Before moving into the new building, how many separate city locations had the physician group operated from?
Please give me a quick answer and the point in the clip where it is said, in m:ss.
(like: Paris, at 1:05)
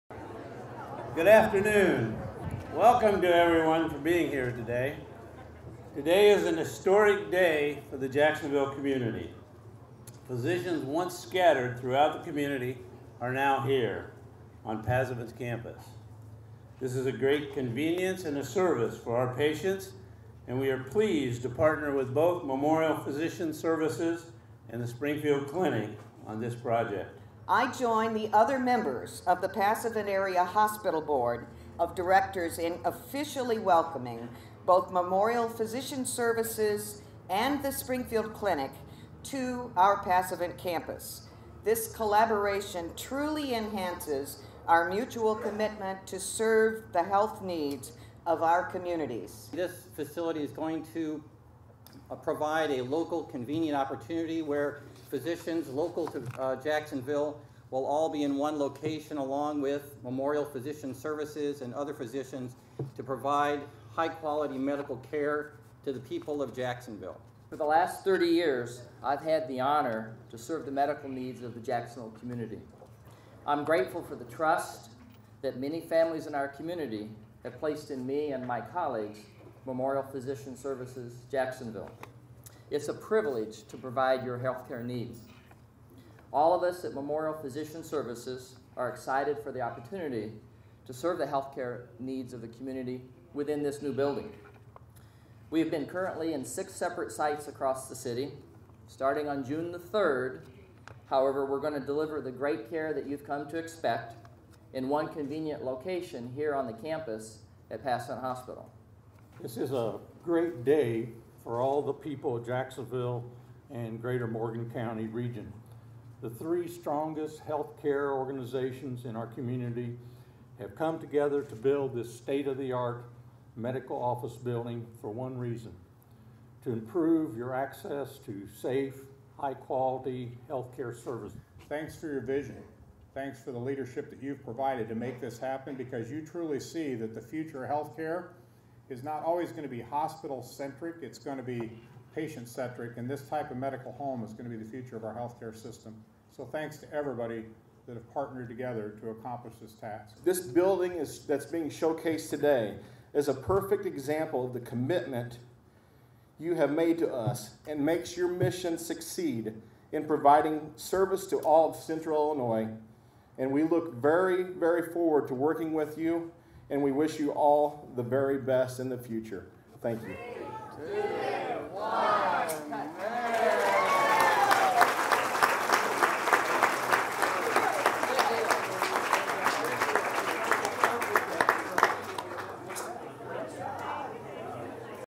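6, at 1:36.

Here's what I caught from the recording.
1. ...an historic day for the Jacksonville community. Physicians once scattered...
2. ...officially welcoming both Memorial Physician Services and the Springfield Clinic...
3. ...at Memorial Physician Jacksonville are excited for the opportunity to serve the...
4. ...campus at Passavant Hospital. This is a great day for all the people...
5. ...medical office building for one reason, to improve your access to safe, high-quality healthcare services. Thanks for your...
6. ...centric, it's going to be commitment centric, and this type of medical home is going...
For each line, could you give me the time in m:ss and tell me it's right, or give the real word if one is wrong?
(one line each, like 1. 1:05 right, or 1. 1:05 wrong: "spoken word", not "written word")
1. 0:06 right
2. 0:32 right
3. 1:26 wrong: "Services", not "Jacksonville"
4. 1:46 right
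5. 2:03 right
6. 2:20 wrong: "patient", not "commitment".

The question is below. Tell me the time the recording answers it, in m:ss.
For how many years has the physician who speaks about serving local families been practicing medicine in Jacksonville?
1:08.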